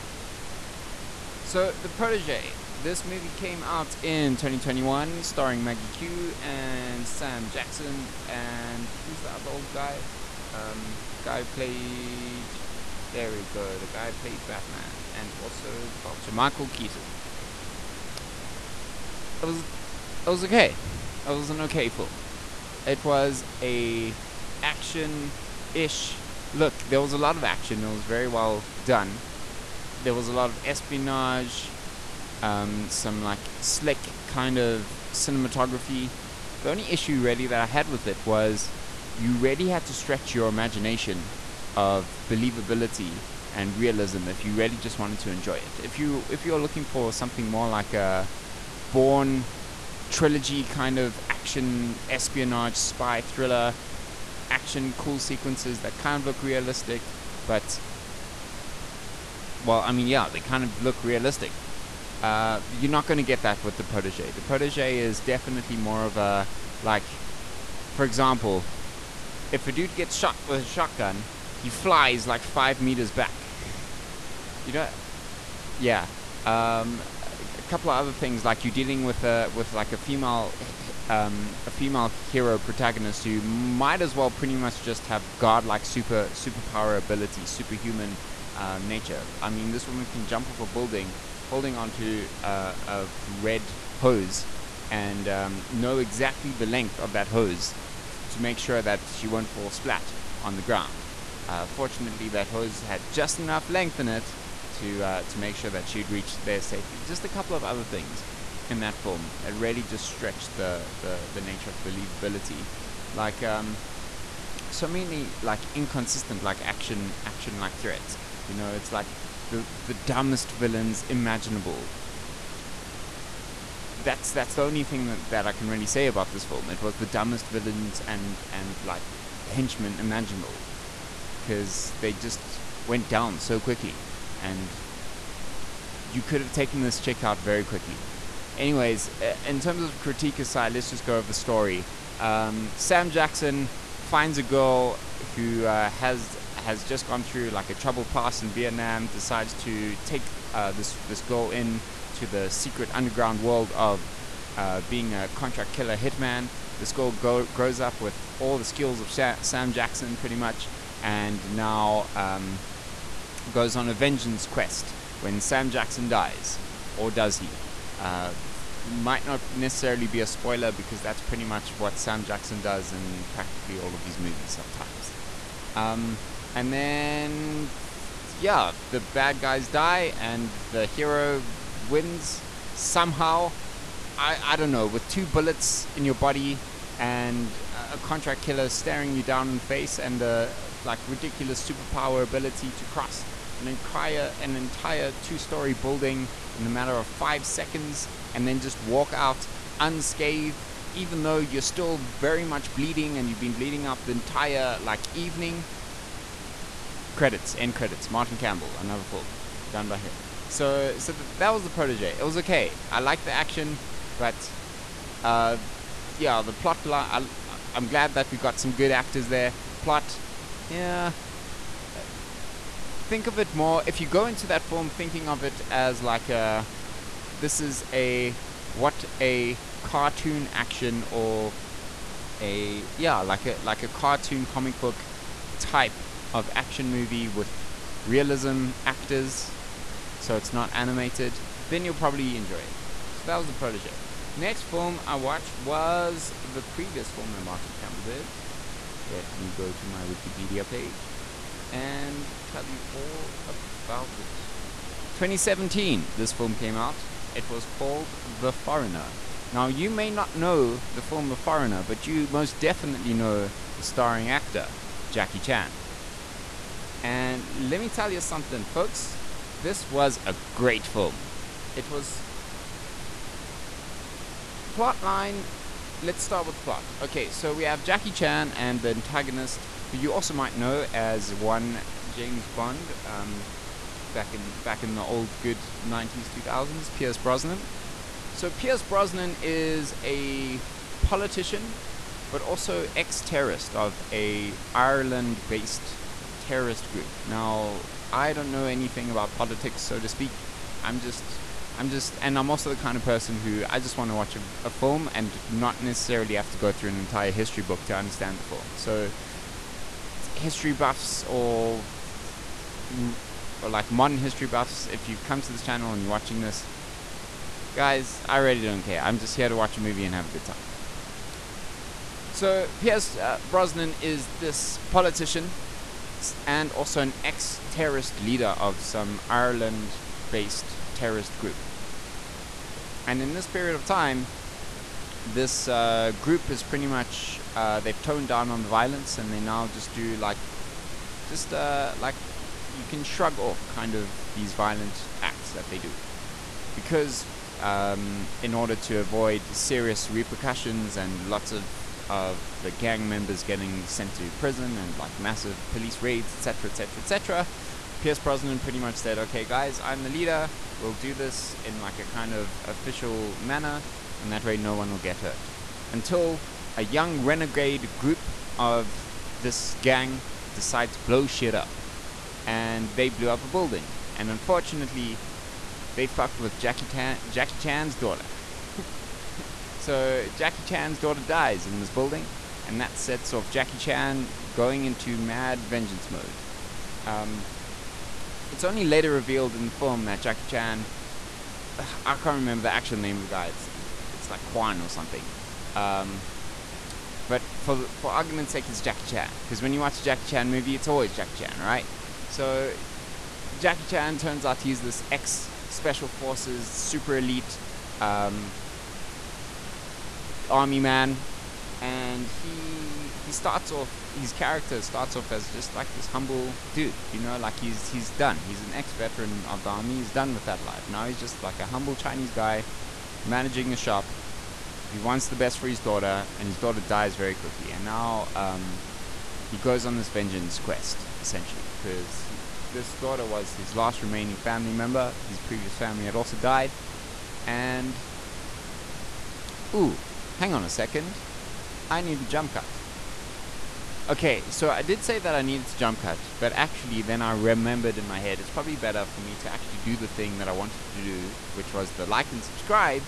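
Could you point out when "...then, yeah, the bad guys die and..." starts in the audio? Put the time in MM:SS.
02:56.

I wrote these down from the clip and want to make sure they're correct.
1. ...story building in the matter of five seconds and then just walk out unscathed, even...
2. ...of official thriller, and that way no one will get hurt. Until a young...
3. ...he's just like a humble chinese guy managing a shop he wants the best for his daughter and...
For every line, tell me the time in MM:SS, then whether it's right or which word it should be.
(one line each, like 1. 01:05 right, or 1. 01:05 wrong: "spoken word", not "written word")
1. 03:15 right
2. 06:02 wrong: "manner", not "thriller"
3. 07:01 right.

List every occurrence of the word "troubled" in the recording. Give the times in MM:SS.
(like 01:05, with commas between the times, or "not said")
02:27.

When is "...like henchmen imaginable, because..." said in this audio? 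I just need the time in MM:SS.
02:08.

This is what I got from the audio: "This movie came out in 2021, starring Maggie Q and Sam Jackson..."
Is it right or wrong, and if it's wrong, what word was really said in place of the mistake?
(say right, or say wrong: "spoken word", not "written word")
right.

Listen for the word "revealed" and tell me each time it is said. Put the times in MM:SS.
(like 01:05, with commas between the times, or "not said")
06:29.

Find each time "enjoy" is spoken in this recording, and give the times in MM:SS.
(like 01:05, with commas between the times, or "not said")
00:45, 04:02.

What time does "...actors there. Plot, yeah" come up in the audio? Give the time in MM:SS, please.
03:38.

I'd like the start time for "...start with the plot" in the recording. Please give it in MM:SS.
04:36.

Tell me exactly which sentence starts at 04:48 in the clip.
So Pierce Brosnan is a politician, but also ex-terrorist of a Ireland-based terrorist group.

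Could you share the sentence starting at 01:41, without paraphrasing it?
Uh, fortunately, that hose had just enough length in it to uh, to make sure that she'd reach there safely.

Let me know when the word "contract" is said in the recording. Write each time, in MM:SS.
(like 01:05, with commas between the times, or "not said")
02:35, 03:07.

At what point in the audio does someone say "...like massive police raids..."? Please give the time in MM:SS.
05:54.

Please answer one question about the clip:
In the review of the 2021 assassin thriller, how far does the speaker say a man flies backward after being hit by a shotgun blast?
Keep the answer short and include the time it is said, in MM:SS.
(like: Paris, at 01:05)
5 meters, at 01:12.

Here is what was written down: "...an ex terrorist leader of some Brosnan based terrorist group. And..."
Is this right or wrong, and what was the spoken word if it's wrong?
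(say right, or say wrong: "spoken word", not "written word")
wrong: "Ireland", not "Brosnan".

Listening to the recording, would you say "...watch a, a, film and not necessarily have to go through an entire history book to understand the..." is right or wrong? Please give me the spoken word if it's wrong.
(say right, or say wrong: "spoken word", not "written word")
right.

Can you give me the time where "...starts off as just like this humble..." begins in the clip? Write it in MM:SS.
06:54.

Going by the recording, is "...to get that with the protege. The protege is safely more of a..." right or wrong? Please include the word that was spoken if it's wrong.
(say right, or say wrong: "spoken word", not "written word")
wrong: "definitely", not "safely".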